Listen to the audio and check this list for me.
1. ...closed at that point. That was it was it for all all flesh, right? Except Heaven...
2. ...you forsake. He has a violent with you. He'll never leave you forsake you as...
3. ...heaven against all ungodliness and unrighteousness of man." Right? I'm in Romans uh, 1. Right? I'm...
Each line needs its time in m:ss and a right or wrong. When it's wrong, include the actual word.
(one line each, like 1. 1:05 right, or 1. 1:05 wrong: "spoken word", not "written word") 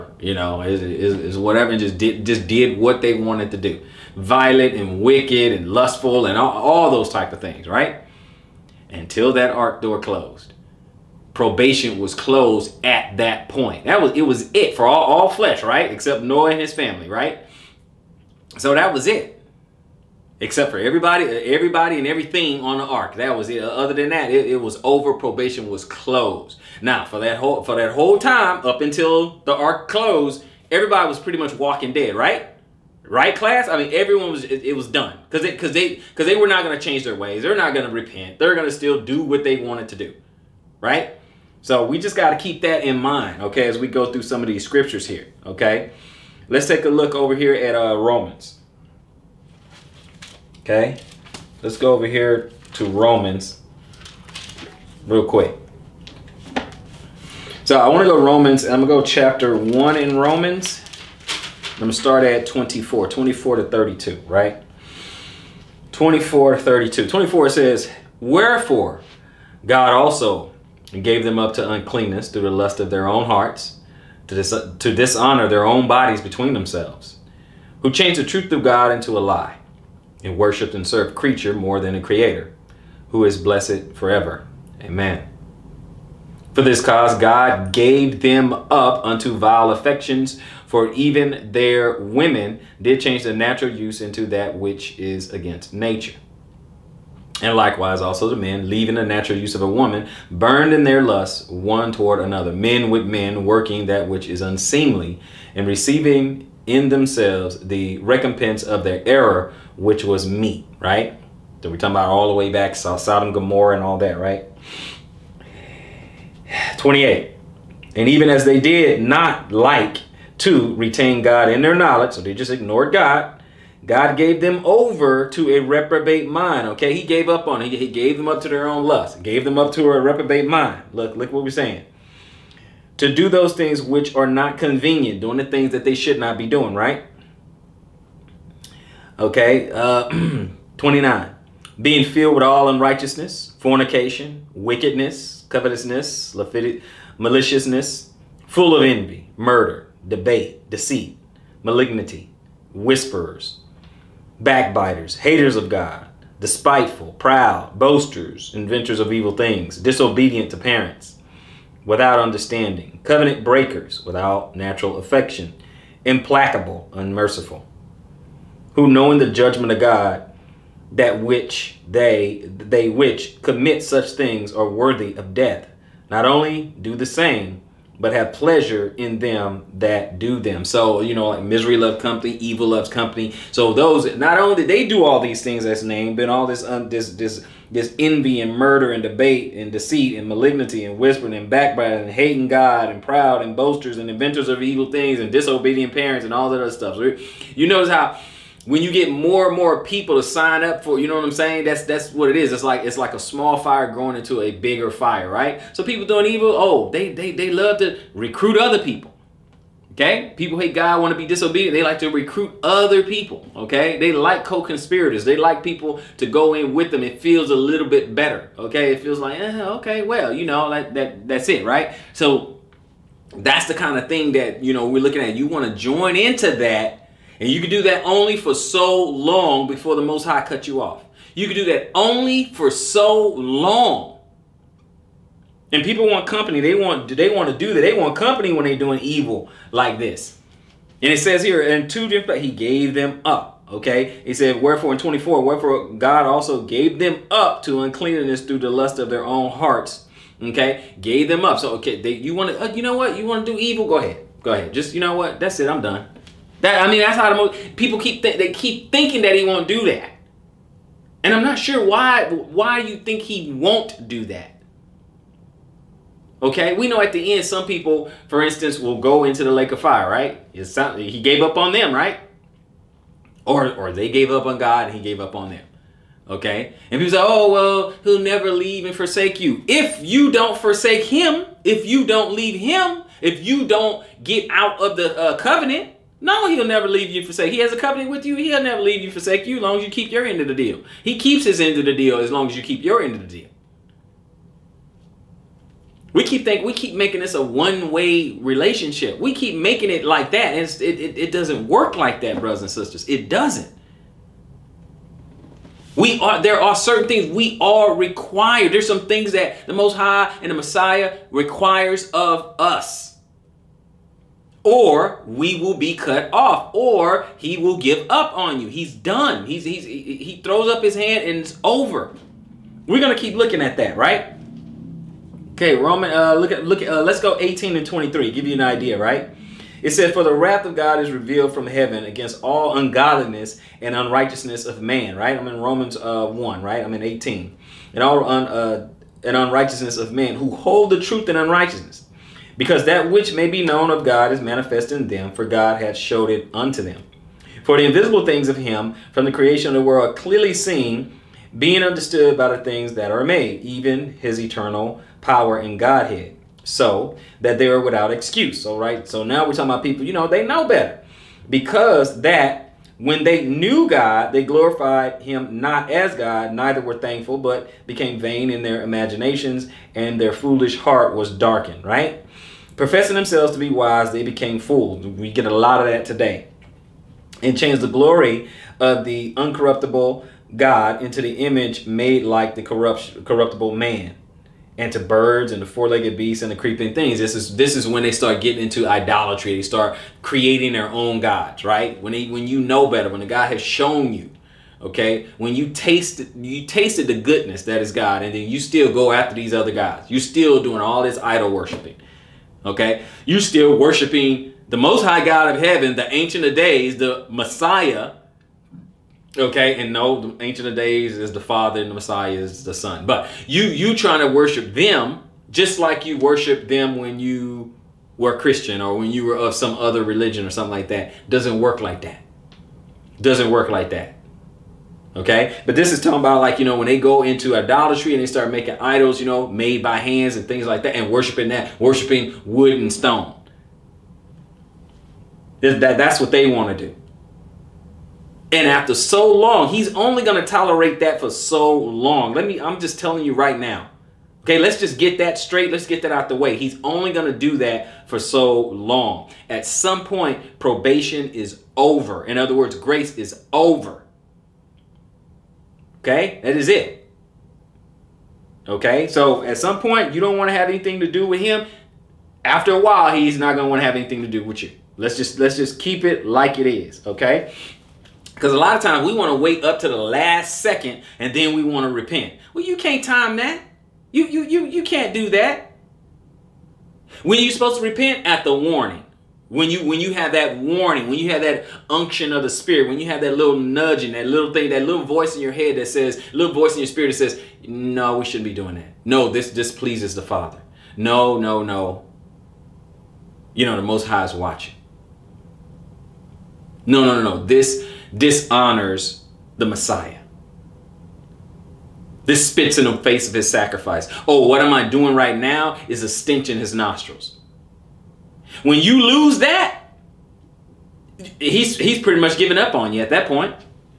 1. 0:12 wrong: "Noah", not "Heaven"
2. 4:47 wrong: "covenant", not "violent"
3. 5:31 right.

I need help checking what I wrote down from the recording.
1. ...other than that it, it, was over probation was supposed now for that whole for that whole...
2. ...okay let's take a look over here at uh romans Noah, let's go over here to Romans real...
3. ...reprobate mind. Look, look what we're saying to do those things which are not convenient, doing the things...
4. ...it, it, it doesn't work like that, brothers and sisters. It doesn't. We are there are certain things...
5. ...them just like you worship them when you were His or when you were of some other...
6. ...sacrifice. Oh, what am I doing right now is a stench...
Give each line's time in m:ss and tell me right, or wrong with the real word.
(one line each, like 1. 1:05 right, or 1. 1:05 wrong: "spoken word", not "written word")
1. 0:23 wrong: "closed", not "supposed"
2. 0:45 wrong: "Okay", not "Noah"
3. 2:10 right
4. 5:00 right
5. 6:54 wrong: "Christian", not "His"
6. 8:23 right.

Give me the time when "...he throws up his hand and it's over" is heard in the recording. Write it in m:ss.
5:19.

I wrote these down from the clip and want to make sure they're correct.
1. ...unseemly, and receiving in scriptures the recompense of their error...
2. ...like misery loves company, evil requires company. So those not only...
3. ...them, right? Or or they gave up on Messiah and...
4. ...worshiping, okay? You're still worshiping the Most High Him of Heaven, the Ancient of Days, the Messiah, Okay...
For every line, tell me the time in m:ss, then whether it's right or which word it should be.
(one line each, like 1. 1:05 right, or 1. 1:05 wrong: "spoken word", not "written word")
1. 1:44 wrong: "themselves", not "scriptures"
2. 3:01 wrong: "loves", not "requires"
3. 4:31 wrong: "God", not "Messiah"
4. 6:41 wrong: "God", not "Him".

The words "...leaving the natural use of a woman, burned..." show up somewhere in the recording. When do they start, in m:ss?
1:38.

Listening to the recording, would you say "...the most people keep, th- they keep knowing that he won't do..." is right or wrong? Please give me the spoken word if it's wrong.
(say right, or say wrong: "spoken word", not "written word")
wrong: "thinking", not "knowing".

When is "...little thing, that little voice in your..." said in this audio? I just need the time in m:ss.
8:04.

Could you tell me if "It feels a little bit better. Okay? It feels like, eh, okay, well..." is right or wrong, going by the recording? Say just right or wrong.
right.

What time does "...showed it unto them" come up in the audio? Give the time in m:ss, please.
5:45.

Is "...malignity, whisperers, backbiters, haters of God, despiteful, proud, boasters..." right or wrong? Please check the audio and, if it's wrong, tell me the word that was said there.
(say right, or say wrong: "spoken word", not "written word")
right.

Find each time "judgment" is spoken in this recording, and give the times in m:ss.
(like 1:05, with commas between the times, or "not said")
2:49.